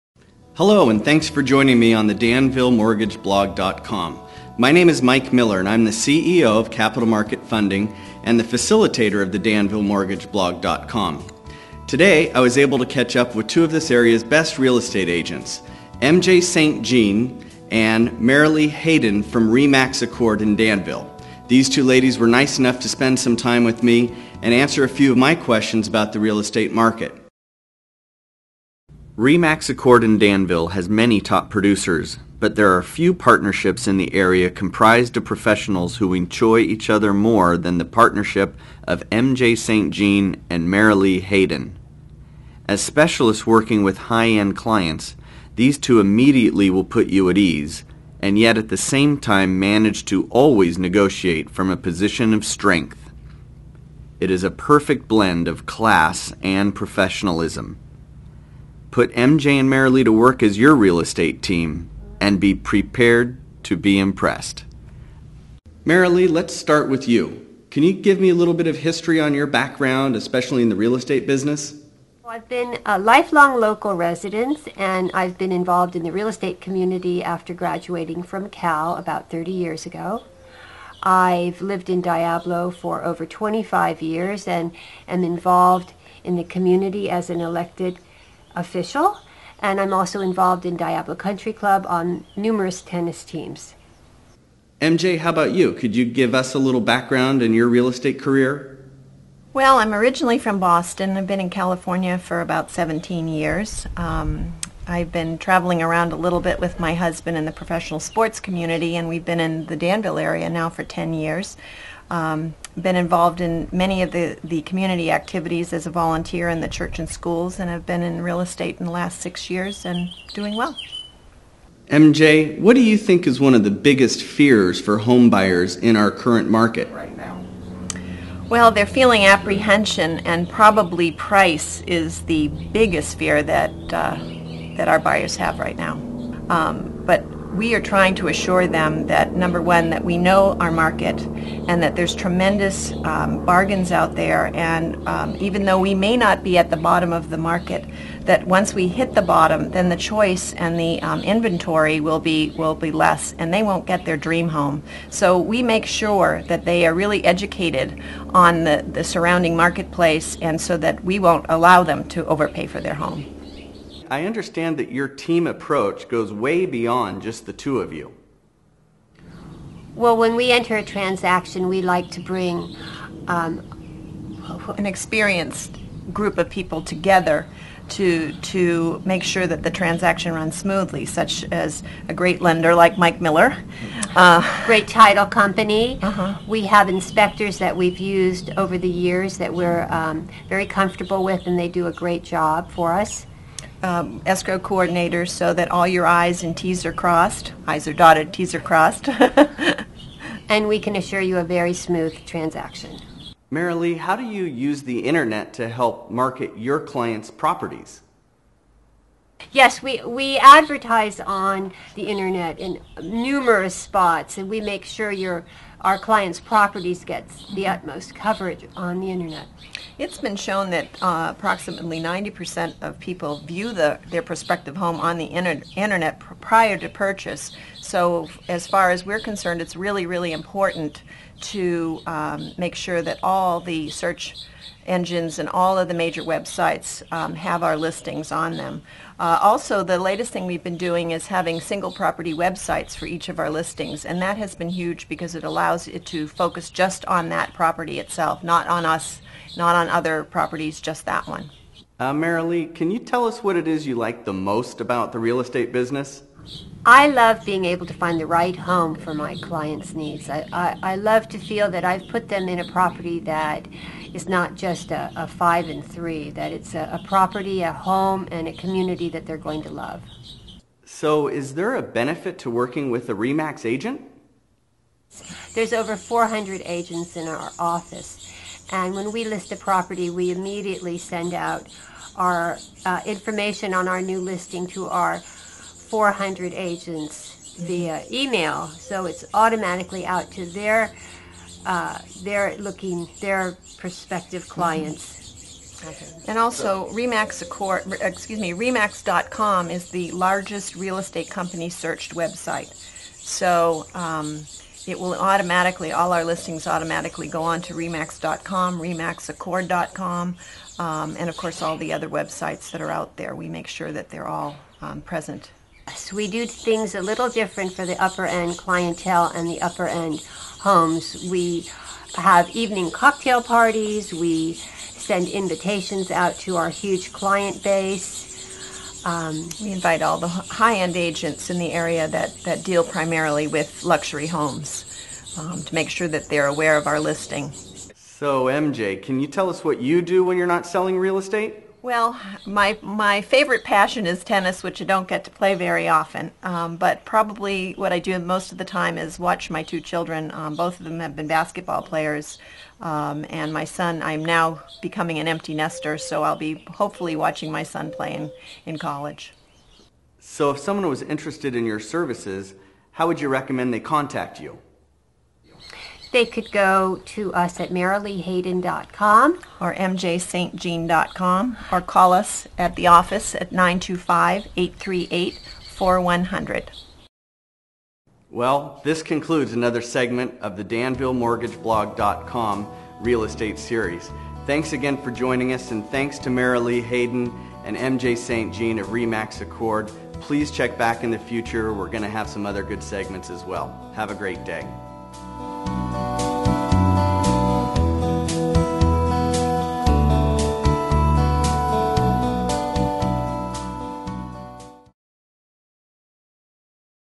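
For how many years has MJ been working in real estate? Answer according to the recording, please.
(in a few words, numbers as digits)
6.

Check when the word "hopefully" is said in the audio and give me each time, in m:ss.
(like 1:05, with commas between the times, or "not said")
5:56.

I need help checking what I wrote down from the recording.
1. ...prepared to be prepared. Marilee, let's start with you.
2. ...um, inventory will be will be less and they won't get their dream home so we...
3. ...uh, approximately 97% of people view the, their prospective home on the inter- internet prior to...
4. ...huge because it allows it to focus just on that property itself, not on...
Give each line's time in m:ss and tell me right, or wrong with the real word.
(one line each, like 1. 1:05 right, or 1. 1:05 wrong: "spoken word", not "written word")
1. 1:02 wrong: "impressed", not "prepared"
2. 2:31 right
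3. 3:41 wrong: "90", not "97"
4. 4:04 right.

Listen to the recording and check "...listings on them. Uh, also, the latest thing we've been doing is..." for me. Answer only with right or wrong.
right.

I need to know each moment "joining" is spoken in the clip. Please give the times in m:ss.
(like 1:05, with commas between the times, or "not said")
0:01, 6:25.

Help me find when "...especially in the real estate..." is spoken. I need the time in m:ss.
1:10.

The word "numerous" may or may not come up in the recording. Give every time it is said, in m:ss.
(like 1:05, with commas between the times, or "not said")
1:32, 3:33.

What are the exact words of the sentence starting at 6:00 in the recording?
So, if someone was interested in your services, how would you recommend they contact you?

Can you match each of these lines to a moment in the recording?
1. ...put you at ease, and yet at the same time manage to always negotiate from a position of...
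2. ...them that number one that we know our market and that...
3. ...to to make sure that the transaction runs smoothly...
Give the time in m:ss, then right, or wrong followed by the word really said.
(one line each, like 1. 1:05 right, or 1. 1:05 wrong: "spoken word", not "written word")
1. 0:46 right
2. 2:18 right
3. 2:57 right.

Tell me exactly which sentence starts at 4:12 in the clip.
Uh, Marilee, can you tell us what it is you like the most about the real estate business?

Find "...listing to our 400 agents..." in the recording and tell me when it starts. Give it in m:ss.
4:44.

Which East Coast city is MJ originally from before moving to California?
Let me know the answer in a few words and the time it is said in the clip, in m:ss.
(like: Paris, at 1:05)
Boston, at 1:40.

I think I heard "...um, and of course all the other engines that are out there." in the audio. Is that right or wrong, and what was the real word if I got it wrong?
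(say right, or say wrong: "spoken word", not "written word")
wrong: "websites", not "engines".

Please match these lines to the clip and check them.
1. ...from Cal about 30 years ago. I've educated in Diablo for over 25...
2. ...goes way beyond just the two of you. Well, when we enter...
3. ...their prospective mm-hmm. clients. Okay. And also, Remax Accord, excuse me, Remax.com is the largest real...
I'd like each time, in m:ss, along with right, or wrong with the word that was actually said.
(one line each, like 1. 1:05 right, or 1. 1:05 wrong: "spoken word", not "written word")
1. 1:18 wrong: "lived", not "educated"
2. 2:46 right
3. 4:53 right.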